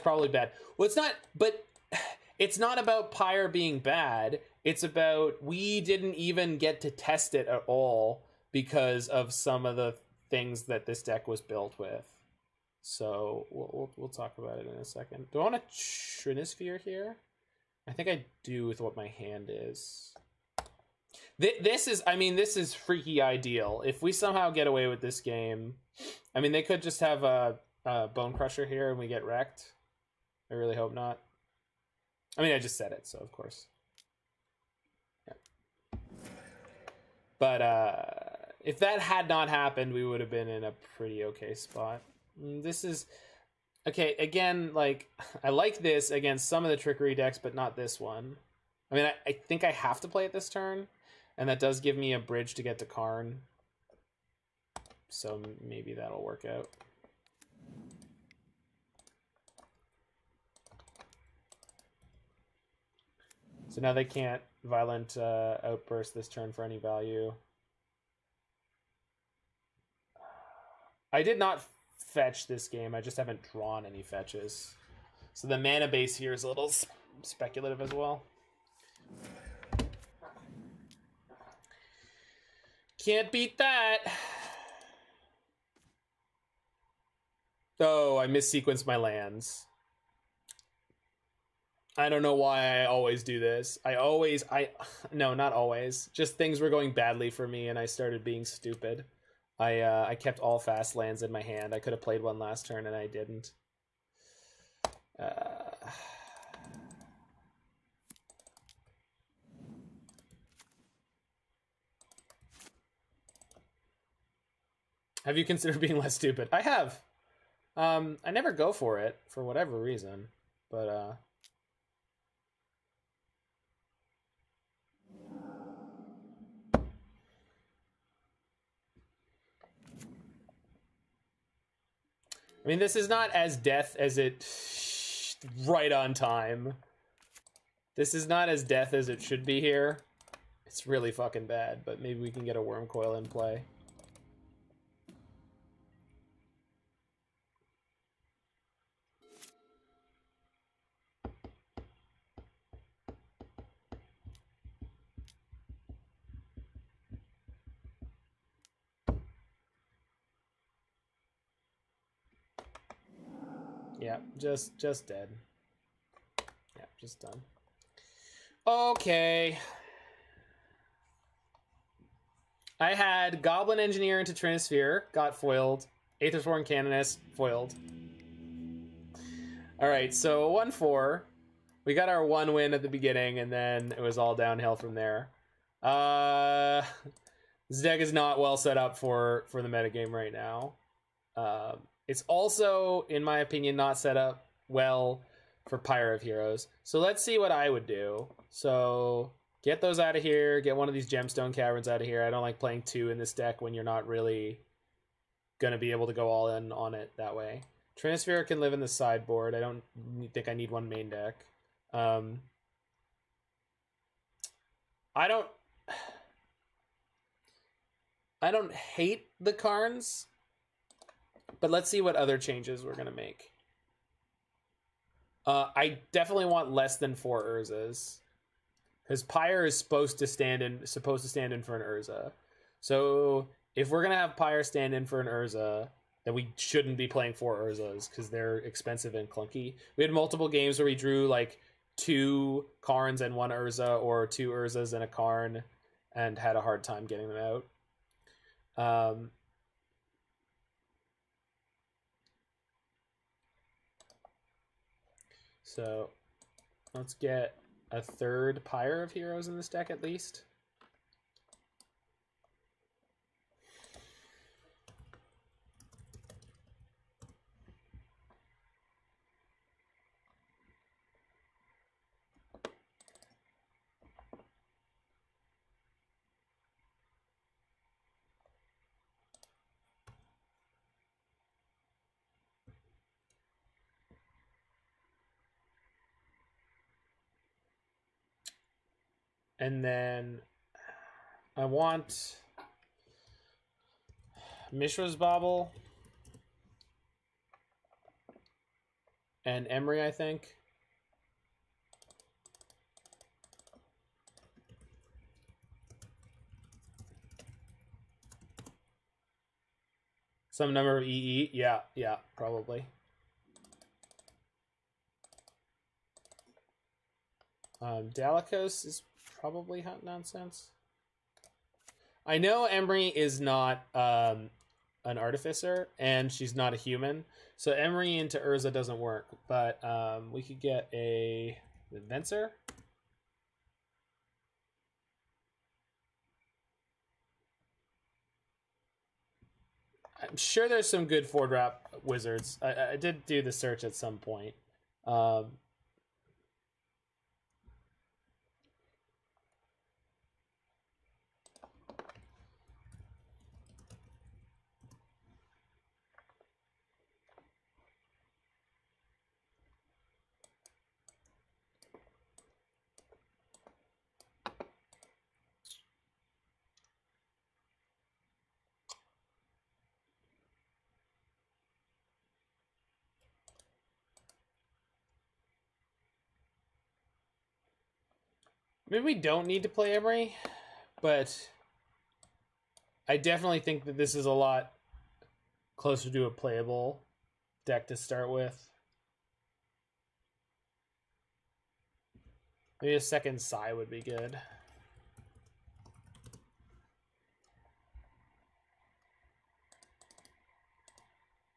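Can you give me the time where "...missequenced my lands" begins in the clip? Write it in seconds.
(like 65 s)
88 s.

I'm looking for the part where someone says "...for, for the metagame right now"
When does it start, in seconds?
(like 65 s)
188 s.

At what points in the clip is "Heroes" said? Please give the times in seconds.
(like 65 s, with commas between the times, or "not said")
196 s, 259 s.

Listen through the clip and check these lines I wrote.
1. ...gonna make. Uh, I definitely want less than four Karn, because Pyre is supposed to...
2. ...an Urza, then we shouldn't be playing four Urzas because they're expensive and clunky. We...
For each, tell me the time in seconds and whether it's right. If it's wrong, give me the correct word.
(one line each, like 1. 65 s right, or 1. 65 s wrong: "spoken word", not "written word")
1. 222 s wrong: "Urzas", not "Karn"
2. 235 s right.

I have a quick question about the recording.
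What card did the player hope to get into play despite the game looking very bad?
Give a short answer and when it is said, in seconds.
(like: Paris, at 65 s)
Wurmcoil, at 142 s.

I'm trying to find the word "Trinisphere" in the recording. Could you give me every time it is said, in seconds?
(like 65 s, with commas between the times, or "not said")
15 s, 174 s, 208 s.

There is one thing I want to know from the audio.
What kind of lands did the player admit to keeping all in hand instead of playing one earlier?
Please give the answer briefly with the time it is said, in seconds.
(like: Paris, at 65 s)
Fast lands, at 100 s.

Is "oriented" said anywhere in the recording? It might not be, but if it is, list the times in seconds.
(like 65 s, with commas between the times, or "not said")
not said.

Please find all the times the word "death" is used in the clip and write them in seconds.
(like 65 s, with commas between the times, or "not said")
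133 s, 138 s.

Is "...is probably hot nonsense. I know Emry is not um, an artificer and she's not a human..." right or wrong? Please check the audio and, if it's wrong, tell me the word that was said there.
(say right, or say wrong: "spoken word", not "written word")
right.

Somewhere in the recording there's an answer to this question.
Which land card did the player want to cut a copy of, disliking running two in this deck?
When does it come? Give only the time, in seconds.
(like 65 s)
201 s.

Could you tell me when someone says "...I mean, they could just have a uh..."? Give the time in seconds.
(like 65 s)
26 s.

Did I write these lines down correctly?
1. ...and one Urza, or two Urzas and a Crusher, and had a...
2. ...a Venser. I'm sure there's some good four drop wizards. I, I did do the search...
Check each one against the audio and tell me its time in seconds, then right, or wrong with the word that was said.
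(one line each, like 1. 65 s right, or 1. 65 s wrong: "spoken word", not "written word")
1. 243 s wrong: "Karn", not "Crusher"
2. 330 s right.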